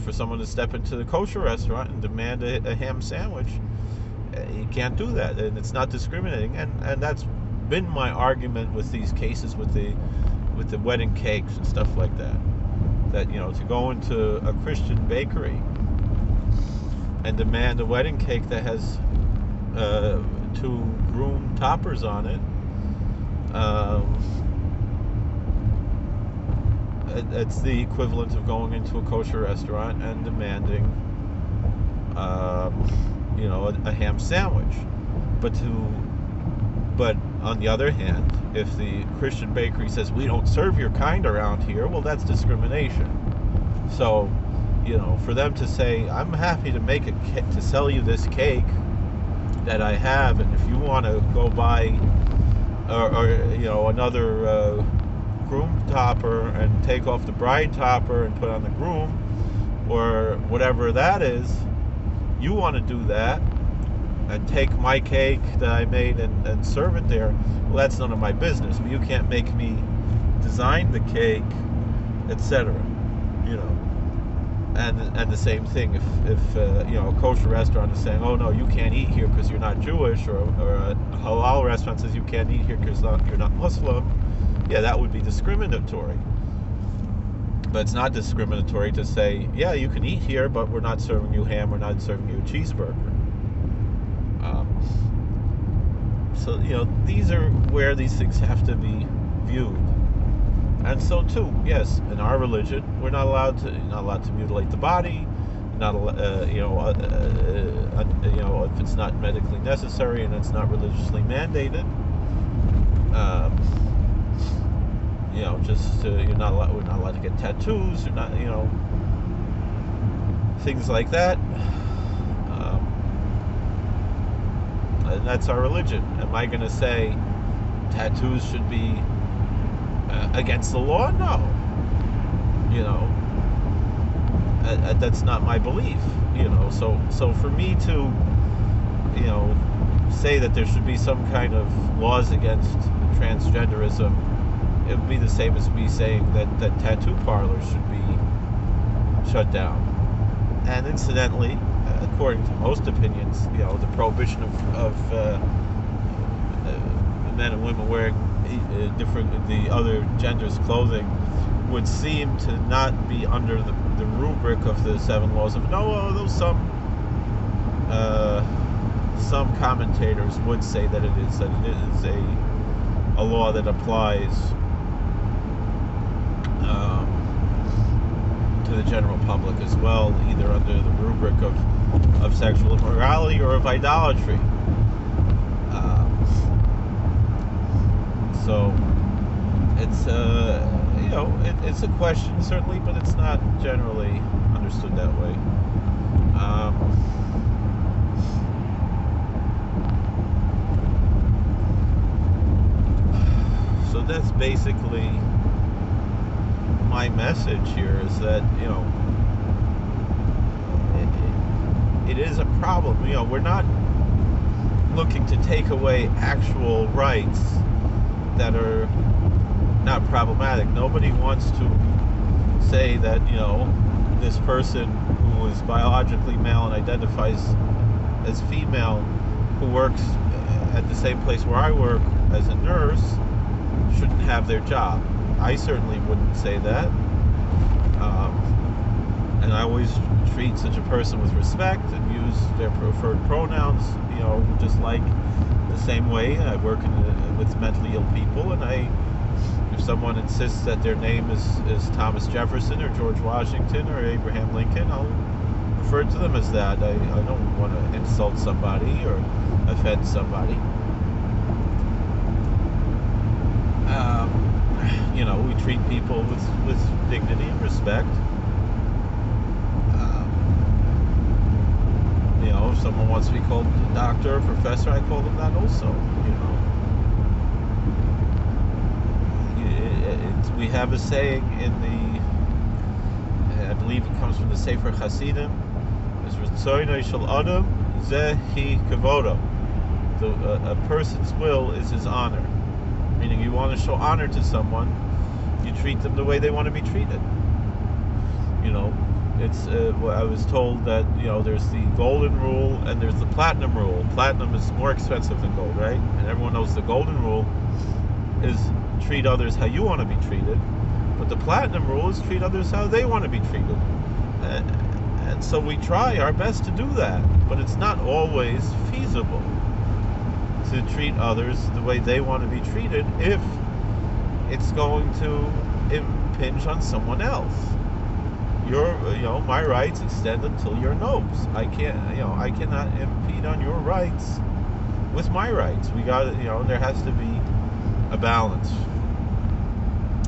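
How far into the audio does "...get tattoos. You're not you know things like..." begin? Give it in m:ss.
1:57.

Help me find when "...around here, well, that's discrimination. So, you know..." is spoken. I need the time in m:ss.
0:41.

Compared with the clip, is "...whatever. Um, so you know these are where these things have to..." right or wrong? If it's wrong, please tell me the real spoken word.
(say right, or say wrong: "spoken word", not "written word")
wrong: "cheeseburger", not "whatever".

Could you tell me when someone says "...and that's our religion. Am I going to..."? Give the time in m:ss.
2:05.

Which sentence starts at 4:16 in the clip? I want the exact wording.
I, I don't want to insult somebody or offend somebody.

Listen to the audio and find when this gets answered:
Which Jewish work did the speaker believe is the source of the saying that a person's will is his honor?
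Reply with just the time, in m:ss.
4:44.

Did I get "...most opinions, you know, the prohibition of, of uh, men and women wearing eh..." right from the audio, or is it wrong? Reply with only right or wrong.
right.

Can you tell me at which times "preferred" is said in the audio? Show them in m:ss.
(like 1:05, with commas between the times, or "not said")
4:02.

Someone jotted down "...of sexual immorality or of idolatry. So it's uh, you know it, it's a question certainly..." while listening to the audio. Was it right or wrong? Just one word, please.
right.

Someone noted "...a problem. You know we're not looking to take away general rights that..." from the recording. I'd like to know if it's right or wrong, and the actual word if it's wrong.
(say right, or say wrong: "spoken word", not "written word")
wrong: "actual", not "general".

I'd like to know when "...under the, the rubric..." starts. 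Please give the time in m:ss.
2:43.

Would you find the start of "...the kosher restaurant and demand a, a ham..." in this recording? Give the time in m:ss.
0:00.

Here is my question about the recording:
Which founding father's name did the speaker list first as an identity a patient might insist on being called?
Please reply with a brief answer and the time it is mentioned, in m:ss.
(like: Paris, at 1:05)
Thomas Jefferson, at 4:11.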